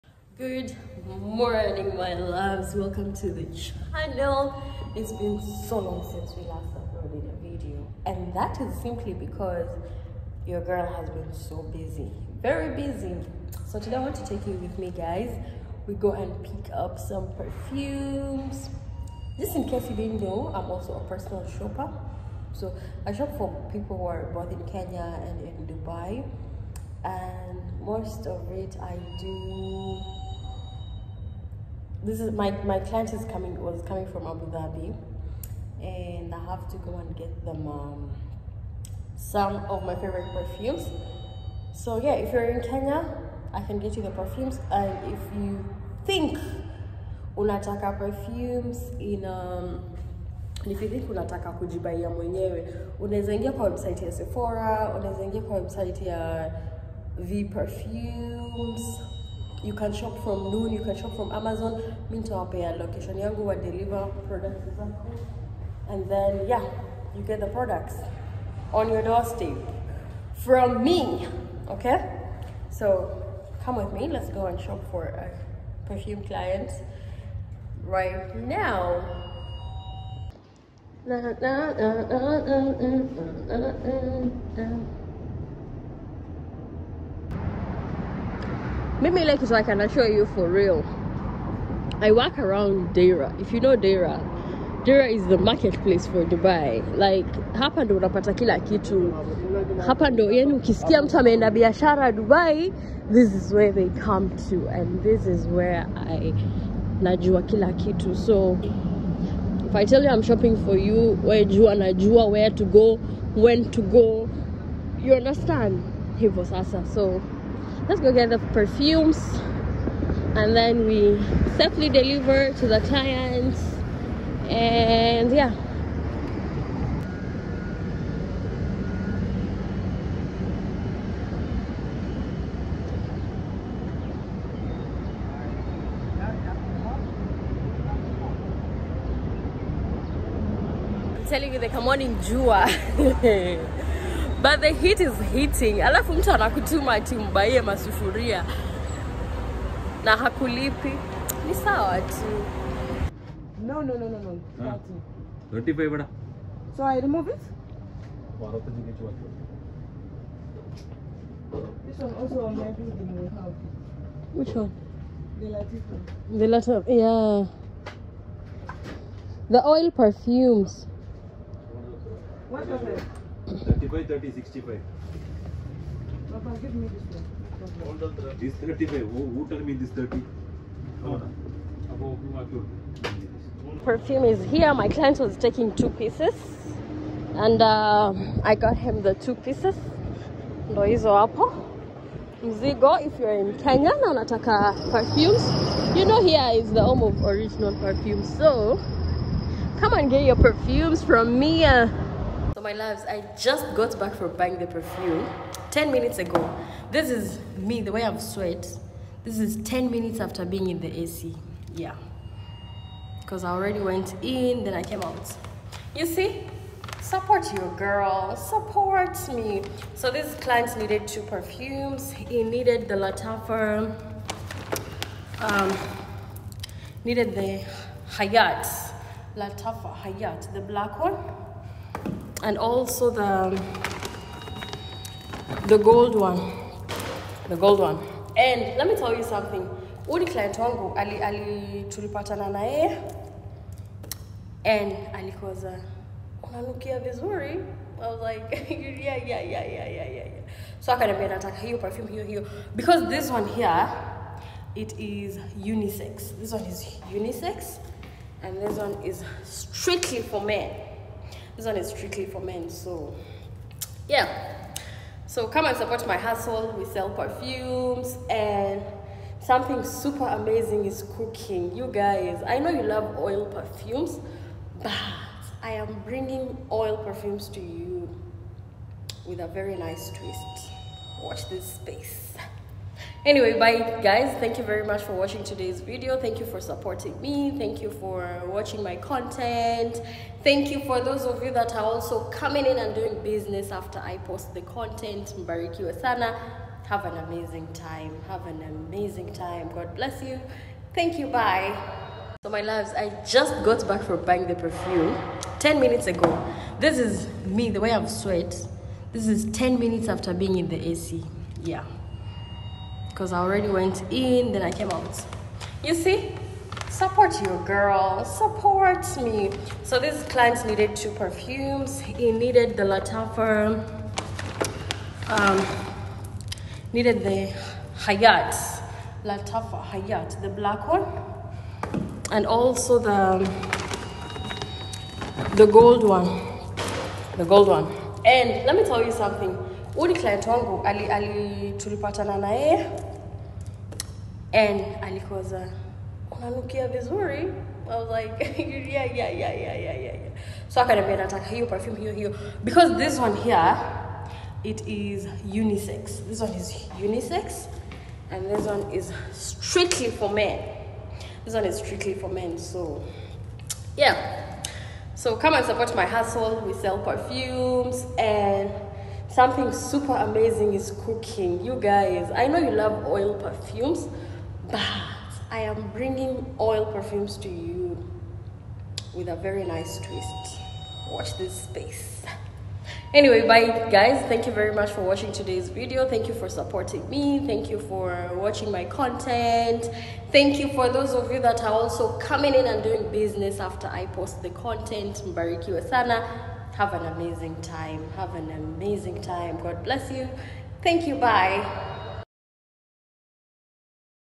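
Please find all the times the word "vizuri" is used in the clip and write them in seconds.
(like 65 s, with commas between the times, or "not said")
246 s, 346 s.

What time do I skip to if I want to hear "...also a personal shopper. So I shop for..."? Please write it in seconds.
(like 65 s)
20 s.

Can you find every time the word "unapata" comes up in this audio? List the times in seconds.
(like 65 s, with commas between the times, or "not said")
97 s.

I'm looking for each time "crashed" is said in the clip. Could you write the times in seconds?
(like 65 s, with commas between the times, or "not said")
not said.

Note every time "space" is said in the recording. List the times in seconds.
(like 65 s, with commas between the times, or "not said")
281 s, 381 s.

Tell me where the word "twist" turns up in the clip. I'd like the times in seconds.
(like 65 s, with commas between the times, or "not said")
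280 s, 379 s.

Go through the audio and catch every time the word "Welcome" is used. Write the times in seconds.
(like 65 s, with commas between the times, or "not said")
2 s.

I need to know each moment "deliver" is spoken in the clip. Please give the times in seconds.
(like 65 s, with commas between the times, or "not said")
63 s, 121 s.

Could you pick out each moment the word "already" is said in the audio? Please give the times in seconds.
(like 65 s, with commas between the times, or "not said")
213 s, 313 s.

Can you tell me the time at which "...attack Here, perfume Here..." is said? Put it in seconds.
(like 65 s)
251 s.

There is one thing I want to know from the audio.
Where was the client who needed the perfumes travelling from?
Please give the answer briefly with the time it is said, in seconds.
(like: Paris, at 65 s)
Abu Dhabi, at 34 s.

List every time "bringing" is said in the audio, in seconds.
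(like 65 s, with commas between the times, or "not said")
276 s, 375 s.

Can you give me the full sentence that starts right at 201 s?
Uh, my loves, I just got back from buying the perfume 10 minutes ago.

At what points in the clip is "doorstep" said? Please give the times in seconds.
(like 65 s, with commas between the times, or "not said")
69 s.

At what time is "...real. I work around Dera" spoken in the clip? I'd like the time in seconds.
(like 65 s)
90 s.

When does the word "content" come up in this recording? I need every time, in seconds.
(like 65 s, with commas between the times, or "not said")
288 s, 294 s, 388 s, 394 s.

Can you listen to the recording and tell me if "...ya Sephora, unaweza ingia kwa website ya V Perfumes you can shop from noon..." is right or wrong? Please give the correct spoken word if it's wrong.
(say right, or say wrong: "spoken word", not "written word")
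right.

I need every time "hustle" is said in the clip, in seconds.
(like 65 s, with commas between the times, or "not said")
266 s, 366 s.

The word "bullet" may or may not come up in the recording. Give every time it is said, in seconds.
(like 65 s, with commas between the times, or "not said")
not said.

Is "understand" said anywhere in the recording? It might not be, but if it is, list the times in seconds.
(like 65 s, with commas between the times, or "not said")
115 s.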